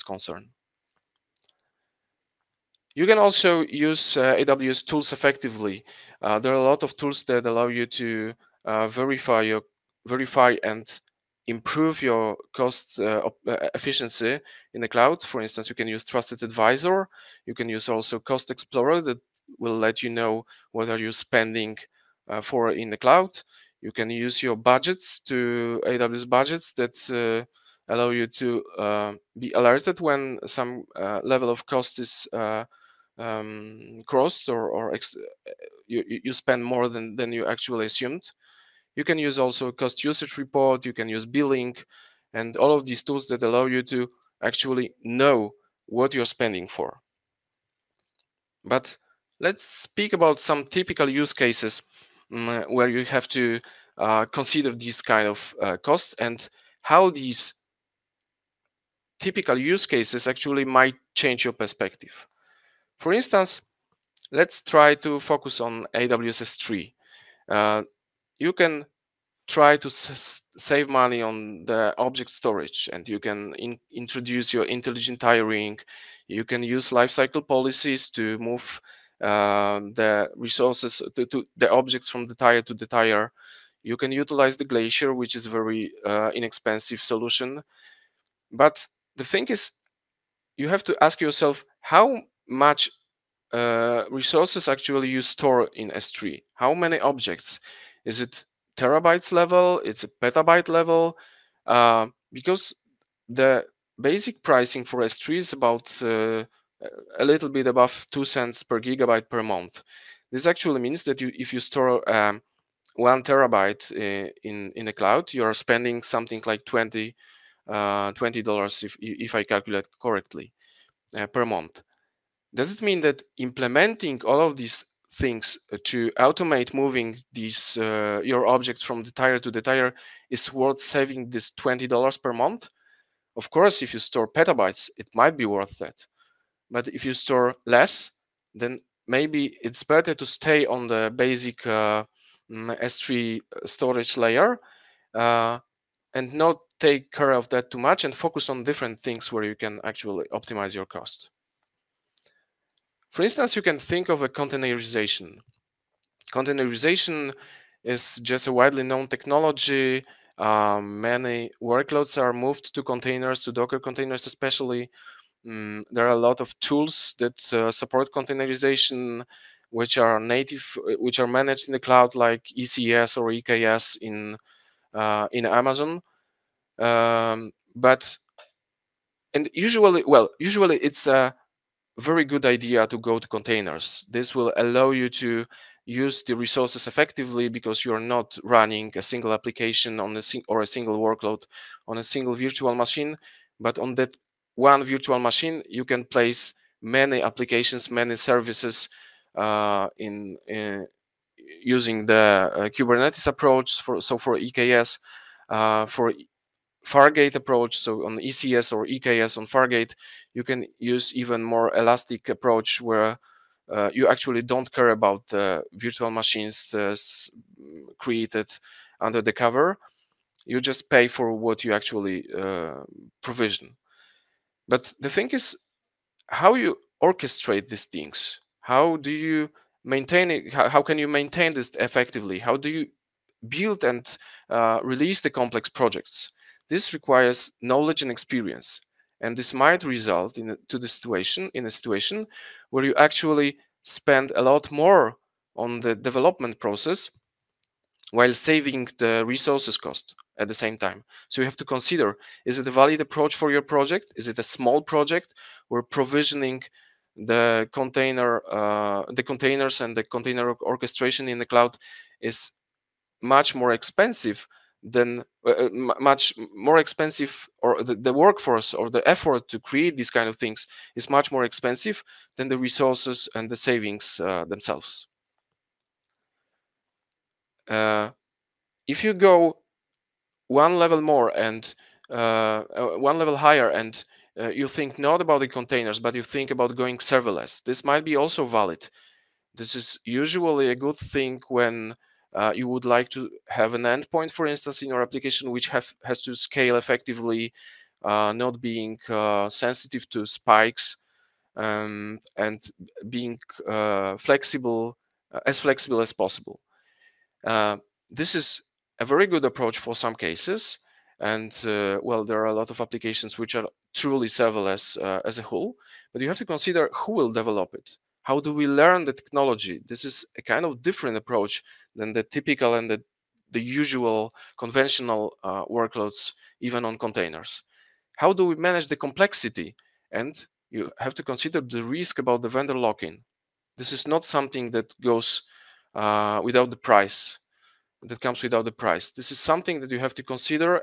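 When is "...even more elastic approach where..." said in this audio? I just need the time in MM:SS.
03:31.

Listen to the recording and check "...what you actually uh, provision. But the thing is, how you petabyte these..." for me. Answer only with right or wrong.
wrong.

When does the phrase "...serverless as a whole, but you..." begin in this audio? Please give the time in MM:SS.
05:14.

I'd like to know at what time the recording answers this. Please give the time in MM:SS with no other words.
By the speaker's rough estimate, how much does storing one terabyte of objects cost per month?
01:56.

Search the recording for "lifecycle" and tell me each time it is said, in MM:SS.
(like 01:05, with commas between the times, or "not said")
01:16.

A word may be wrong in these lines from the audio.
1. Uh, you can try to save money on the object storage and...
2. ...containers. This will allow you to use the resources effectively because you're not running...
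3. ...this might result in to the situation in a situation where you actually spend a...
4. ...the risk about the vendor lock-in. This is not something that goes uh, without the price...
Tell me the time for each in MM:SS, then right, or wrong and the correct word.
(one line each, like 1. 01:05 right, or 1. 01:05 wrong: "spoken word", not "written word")
1. 01:07 right
2. 03:03 right
3. 03:59 right
4. 05:31 right.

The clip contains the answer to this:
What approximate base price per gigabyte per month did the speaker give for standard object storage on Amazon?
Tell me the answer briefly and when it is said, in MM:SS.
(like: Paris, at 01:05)
2 cents, at 01:48.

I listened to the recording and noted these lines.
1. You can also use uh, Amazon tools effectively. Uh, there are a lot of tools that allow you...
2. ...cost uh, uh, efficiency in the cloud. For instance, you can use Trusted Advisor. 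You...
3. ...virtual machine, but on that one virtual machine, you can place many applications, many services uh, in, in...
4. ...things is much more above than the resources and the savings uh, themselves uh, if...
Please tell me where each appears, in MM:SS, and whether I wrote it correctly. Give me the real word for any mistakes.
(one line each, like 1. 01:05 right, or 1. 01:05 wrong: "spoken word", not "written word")
1. 00:02 wrong: "AWS", not "Amazon"
2. 00:12 right
3. 03:12 right
4. 04:30 wrong: "expensive", not "above".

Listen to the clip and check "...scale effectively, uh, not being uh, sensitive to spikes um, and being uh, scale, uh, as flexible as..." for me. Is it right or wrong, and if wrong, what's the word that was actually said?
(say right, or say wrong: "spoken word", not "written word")
wrong: "flexible", not "scale".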